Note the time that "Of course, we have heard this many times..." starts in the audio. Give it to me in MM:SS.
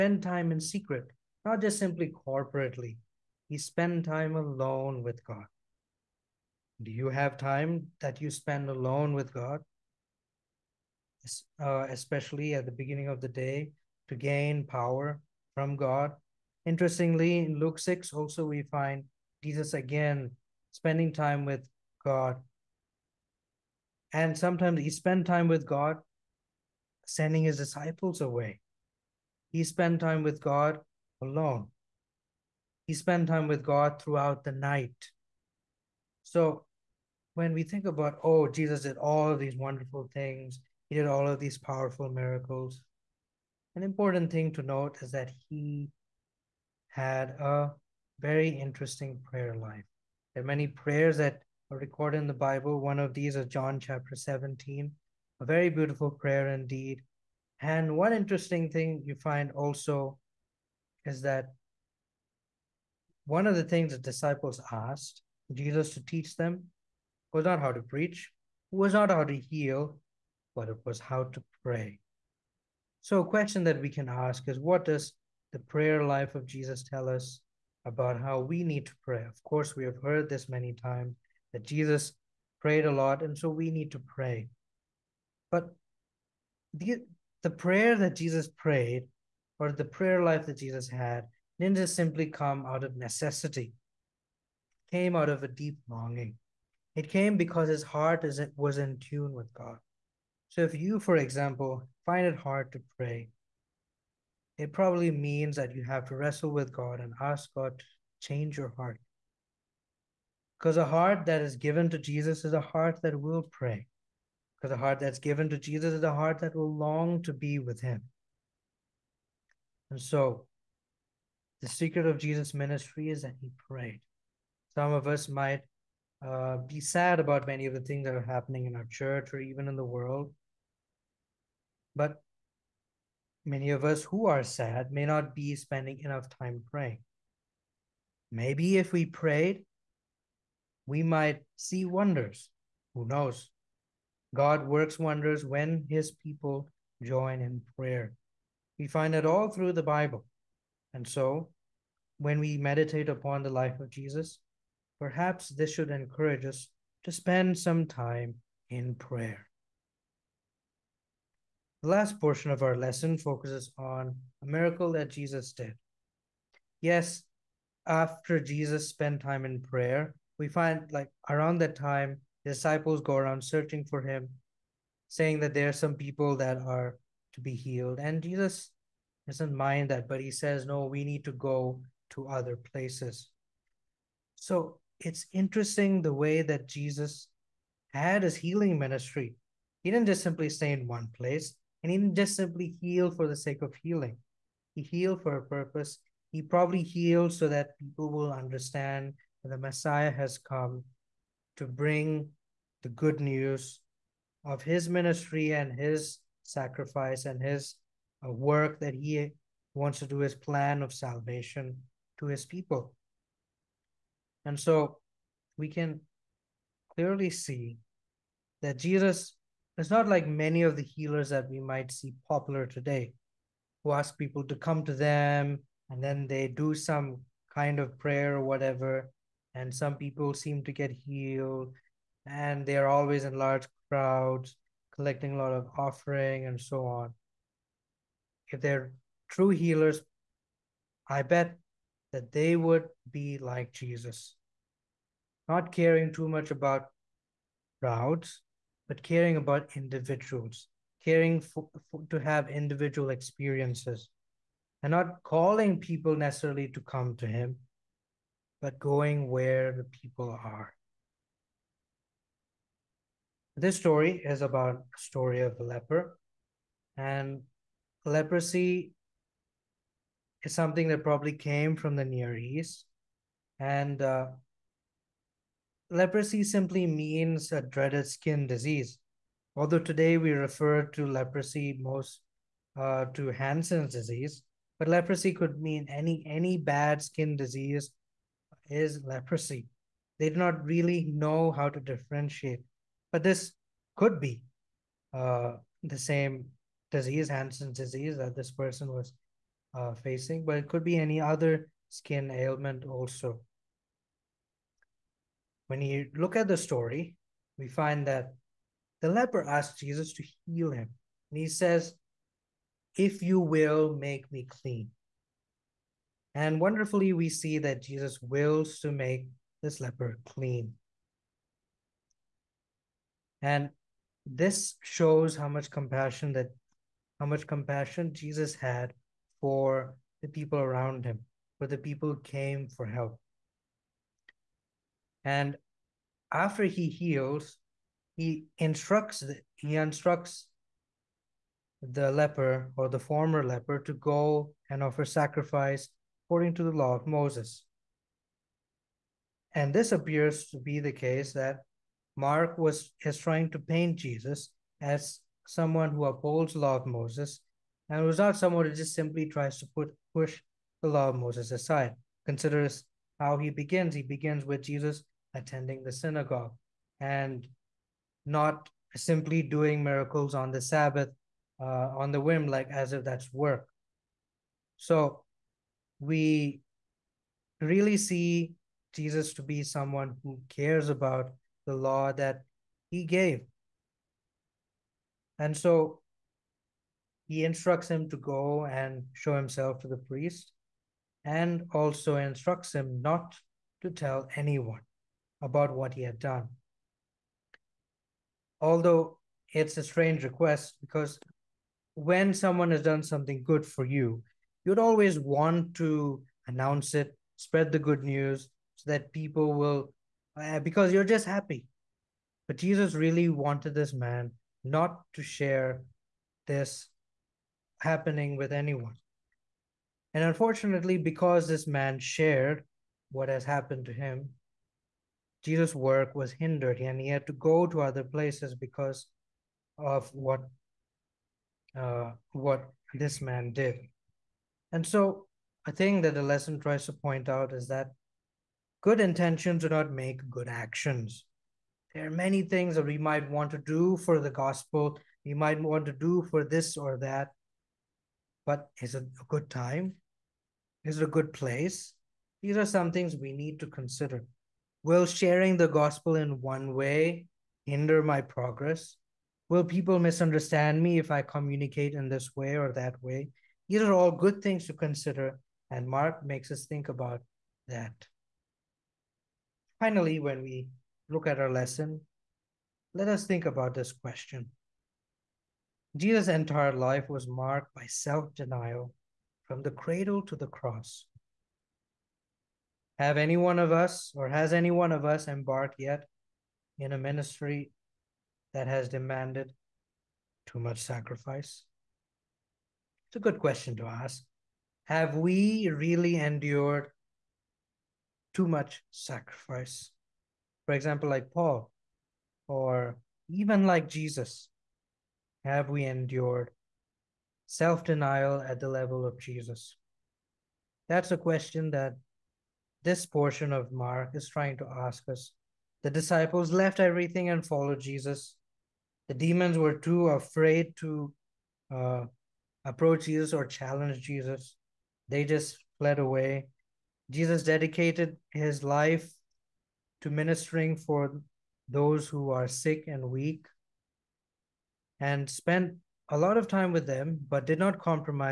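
01:19.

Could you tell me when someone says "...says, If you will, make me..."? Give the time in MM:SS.
05:11.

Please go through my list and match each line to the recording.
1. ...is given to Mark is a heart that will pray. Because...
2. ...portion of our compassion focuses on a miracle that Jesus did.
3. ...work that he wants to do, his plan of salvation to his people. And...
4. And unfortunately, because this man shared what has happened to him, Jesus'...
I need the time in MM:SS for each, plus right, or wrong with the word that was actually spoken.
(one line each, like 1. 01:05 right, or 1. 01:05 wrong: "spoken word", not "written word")
1. 01:51 wrong: "Jesus", not "Mark"
2. 02:42 wrong: "lesson", not "compassion"
3. 03:28 right
4. 07:00 right.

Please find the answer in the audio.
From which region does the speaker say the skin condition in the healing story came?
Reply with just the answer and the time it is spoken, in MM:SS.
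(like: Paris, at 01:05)
The Near East, at 04:32.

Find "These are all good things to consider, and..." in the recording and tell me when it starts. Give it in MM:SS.
07:43.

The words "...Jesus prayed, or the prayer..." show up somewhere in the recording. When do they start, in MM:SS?
01:28.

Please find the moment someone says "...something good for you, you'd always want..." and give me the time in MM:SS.
06:43.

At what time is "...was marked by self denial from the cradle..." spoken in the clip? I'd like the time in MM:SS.
07:57.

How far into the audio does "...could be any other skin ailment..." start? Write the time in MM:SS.
05:00.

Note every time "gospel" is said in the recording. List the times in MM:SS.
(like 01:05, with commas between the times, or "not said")
07:24, 07:35.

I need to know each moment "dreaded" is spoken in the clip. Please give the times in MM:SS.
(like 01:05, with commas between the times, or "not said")
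04:37.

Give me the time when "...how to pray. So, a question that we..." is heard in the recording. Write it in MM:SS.
01:10.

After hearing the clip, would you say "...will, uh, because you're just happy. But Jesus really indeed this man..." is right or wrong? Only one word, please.
wrong.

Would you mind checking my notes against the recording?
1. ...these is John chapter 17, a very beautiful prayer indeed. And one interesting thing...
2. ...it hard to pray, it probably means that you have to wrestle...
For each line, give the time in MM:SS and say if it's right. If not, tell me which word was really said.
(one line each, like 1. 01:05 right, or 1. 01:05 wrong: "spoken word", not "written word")
1. 00:53 right
2. 01:42 right.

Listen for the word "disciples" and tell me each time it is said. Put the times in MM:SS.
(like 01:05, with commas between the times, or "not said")
00:27, 01:03, 02:52, 08:35.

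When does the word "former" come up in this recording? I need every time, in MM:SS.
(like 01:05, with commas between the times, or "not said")
05:42.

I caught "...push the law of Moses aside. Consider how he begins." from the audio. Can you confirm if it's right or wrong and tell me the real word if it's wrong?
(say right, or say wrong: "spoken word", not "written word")
right.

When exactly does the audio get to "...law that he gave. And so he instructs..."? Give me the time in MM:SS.
06:21.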